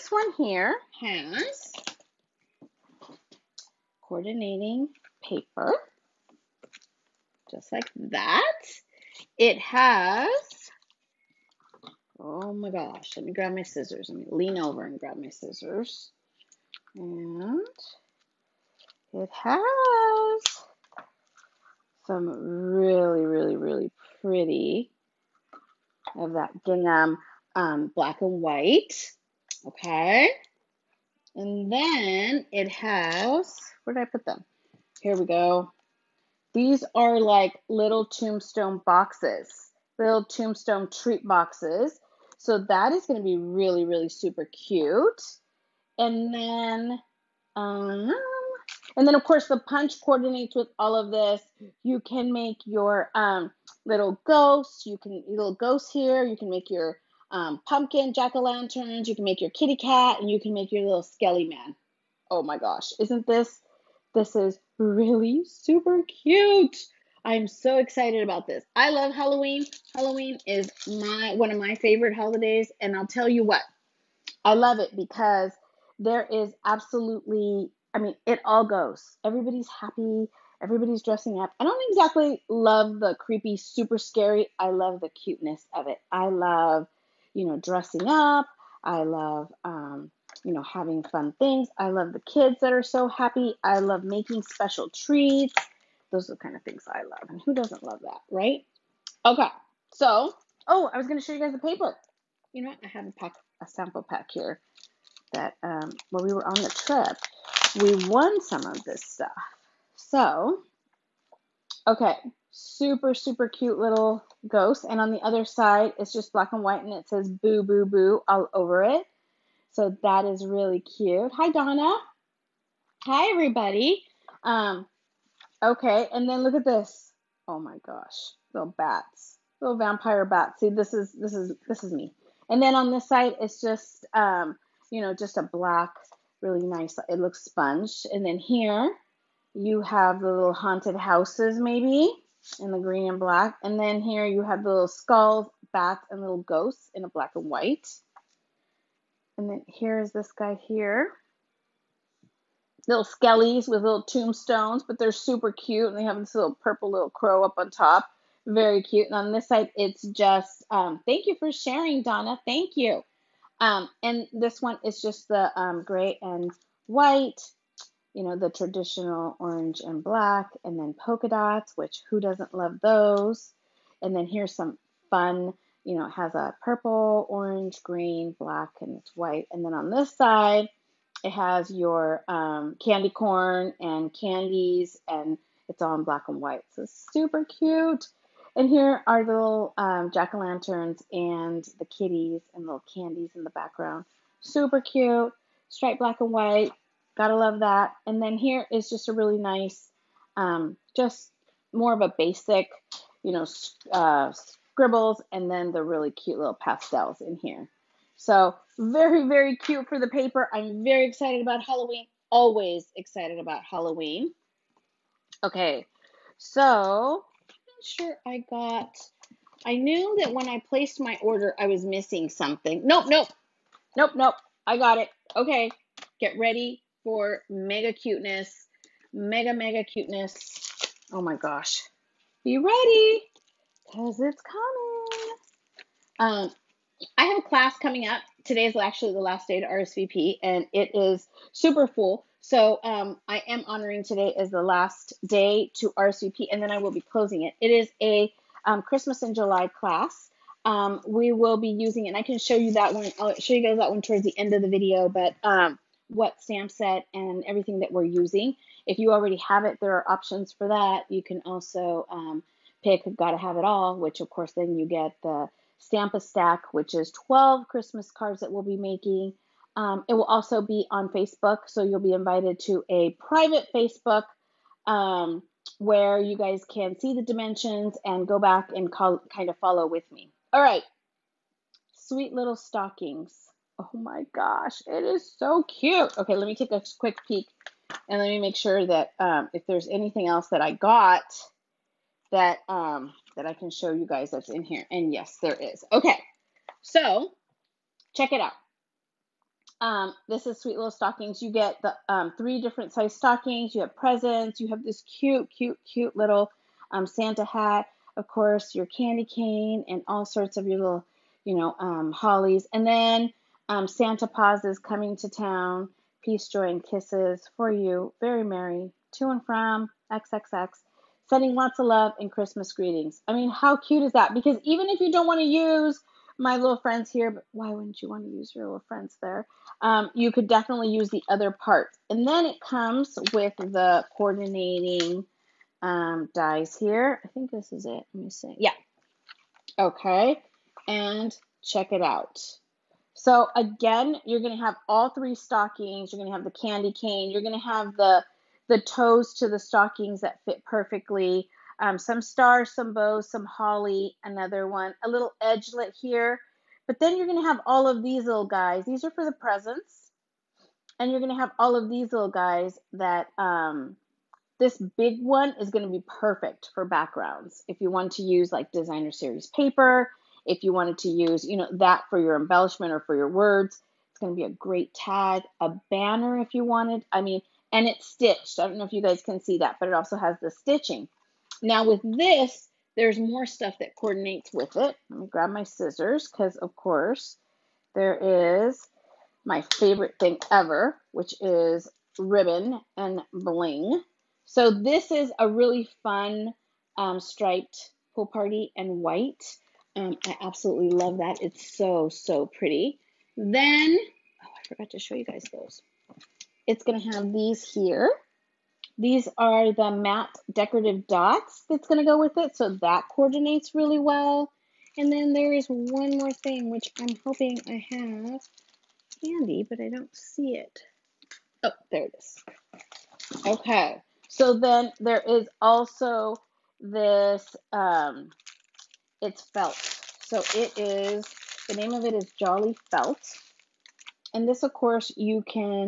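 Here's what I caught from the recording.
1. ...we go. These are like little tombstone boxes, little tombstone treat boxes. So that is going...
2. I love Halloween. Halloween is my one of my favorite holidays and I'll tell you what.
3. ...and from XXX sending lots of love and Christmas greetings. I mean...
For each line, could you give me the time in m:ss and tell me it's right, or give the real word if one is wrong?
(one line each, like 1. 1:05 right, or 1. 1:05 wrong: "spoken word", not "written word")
1. 0:35 right
2. 1:08 right
3. 5:19 right.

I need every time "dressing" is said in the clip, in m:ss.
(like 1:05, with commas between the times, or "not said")
1:21, 1:27.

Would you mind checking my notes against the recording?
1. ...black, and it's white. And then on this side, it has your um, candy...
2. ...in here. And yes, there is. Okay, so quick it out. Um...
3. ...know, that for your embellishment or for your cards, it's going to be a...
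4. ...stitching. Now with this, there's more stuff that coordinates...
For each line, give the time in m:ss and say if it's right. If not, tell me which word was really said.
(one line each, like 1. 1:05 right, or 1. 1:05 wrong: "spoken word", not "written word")
1. 2:58 right
2. 4:54 wrong: "check", not "quick"
3. 6:11 wrong: "words", not "cards"
4. 6:20 right.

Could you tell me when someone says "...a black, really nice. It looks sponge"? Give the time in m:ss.
2:15.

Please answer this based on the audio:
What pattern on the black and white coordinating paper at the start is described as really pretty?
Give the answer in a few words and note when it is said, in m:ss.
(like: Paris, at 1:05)
Gingham, at 0:26.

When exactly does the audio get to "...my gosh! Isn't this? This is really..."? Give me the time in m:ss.
1:02.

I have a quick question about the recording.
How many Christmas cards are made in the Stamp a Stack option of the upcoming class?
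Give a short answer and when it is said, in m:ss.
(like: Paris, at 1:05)
12, at 4:27.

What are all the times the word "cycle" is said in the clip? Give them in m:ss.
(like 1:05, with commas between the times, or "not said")
not said.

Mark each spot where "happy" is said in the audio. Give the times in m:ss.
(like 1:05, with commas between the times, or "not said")
1:19, 1:33.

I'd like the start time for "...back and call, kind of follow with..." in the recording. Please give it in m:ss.
4:38.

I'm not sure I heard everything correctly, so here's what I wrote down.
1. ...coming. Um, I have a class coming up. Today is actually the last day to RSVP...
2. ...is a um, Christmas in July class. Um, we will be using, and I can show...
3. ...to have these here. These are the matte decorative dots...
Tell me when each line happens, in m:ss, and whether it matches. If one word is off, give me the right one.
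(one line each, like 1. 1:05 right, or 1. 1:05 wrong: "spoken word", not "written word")
1. 3:54 right
2. 4:07 right
3. 6:46 right.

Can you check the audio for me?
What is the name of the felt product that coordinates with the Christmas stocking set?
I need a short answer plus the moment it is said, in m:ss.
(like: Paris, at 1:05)
Jolly Felt, at 7:12.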